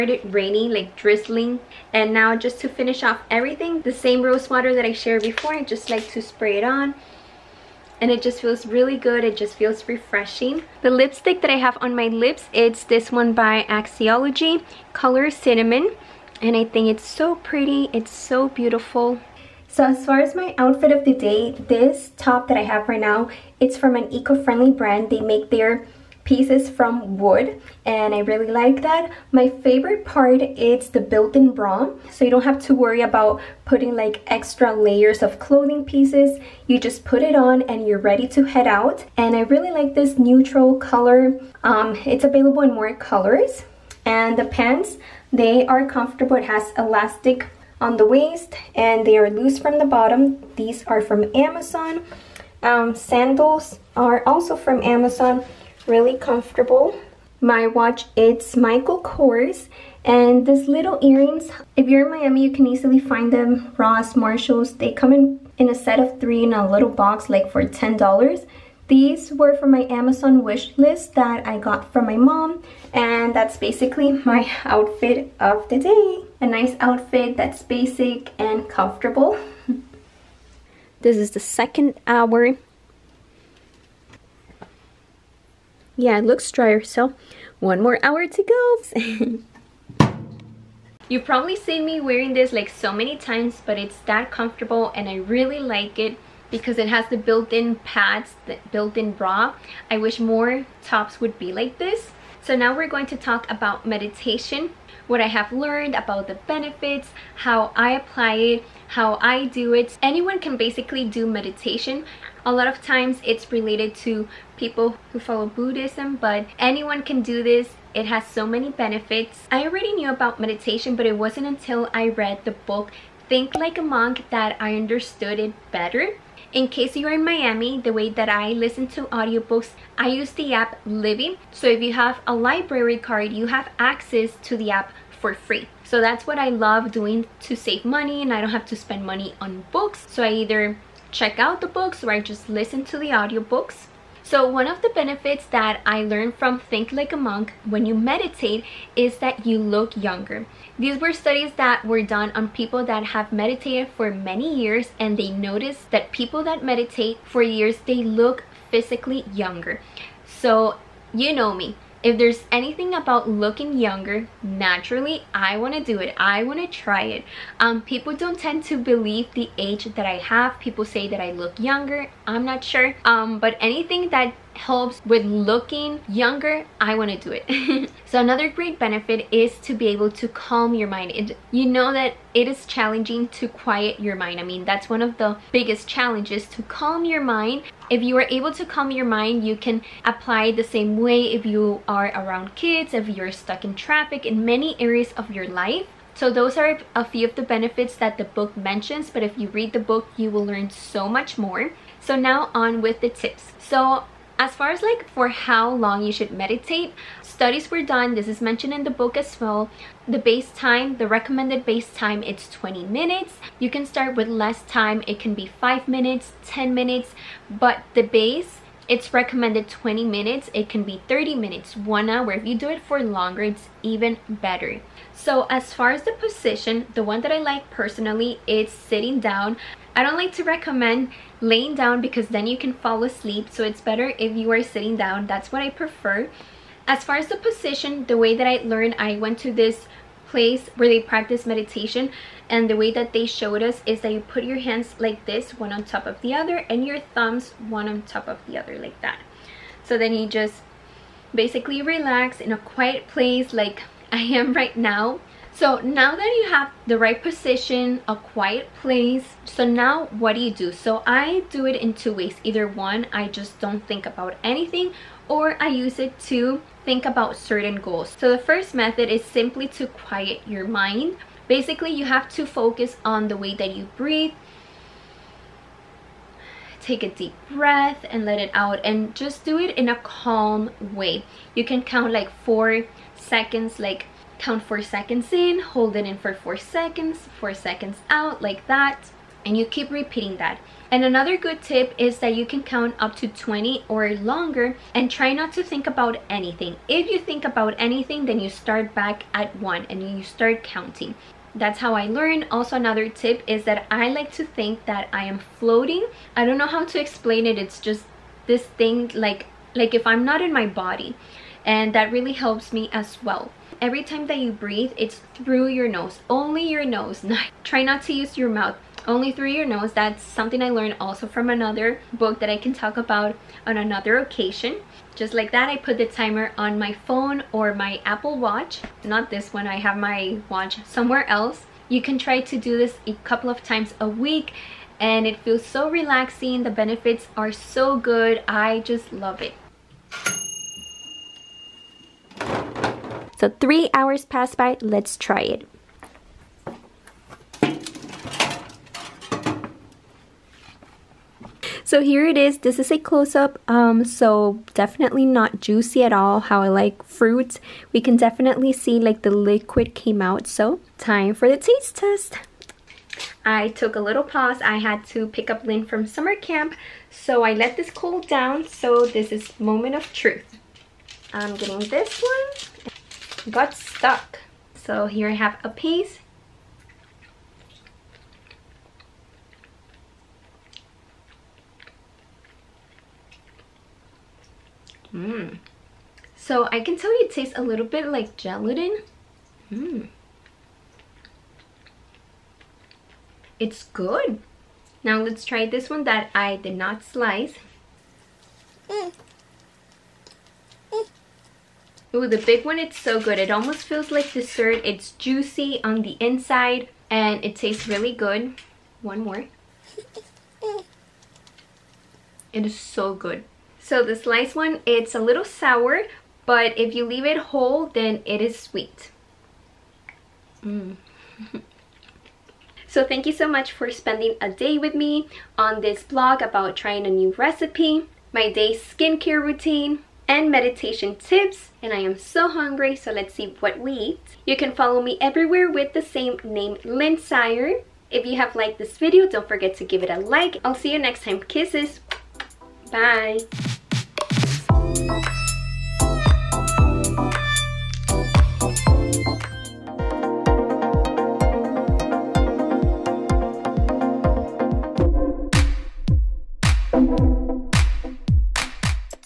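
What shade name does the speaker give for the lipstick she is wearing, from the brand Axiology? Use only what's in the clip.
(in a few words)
Cinnamon.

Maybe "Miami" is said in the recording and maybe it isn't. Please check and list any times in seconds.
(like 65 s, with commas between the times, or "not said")
62 s, 127 s.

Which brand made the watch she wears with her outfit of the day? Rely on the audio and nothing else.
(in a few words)
Michael Kors.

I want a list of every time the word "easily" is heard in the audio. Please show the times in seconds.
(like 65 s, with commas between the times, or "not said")
62 s.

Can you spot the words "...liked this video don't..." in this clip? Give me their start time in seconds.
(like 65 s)
438 s.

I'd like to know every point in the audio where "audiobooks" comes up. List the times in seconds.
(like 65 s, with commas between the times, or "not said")
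129 s, 143 s.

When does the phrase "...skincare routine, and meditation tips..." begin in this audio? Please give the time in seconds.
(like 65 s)
428 s.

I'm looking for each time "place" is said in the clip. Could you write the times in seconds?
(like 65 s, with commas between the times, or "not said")
240 s, 253 s, 258 s.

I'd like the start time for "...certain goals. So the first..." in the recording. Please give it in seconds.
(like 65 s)
267 s.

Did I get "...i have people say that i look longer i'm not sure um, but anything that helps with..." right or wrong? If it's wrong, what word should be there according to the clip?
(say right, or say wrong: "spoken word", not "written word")
wrong: "younger", not "longer".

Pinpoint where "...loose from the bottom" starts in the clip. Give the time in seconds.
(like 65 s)
49 s.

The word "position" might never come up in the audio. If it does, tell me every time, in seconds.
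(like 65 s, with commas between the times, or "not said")
226 s, 237 s, 257 s.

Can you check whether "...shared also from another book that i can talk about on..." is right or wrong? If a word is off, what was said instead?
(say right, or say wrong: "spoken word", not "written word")
wrong: "learned", not "shared".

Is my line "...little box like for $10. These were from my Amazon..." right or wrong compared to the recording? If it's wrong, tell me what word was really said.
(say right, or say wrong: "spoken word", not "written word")
right.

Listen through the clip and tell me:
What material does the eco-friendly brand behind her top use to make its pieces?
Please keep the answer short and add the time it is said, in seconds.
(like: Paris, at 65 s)
Wood, at 27 s.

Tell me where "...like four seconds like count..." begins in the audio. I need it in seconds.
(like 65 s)
282 s.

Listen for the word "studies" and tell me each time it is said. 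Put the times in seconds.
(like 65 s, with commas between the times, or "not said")
151 s, 207 s.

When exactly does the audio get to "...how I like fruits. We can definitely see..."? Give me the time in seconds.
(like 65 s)
356 s.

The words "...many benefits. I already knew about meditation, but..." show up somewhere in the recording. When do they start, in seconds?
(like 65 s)
118 s.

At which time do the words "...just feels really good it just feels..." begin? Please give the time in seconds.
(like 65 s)
8 s.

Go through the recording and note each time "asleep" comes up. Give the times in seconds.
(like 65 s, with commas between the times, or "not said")
233 s.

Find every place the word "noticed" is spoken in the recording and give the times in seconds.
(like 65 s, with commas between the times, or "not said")
155 s.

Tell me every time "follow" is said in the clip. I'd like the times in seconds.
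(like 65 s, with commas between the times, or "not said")
115 s, 434 s.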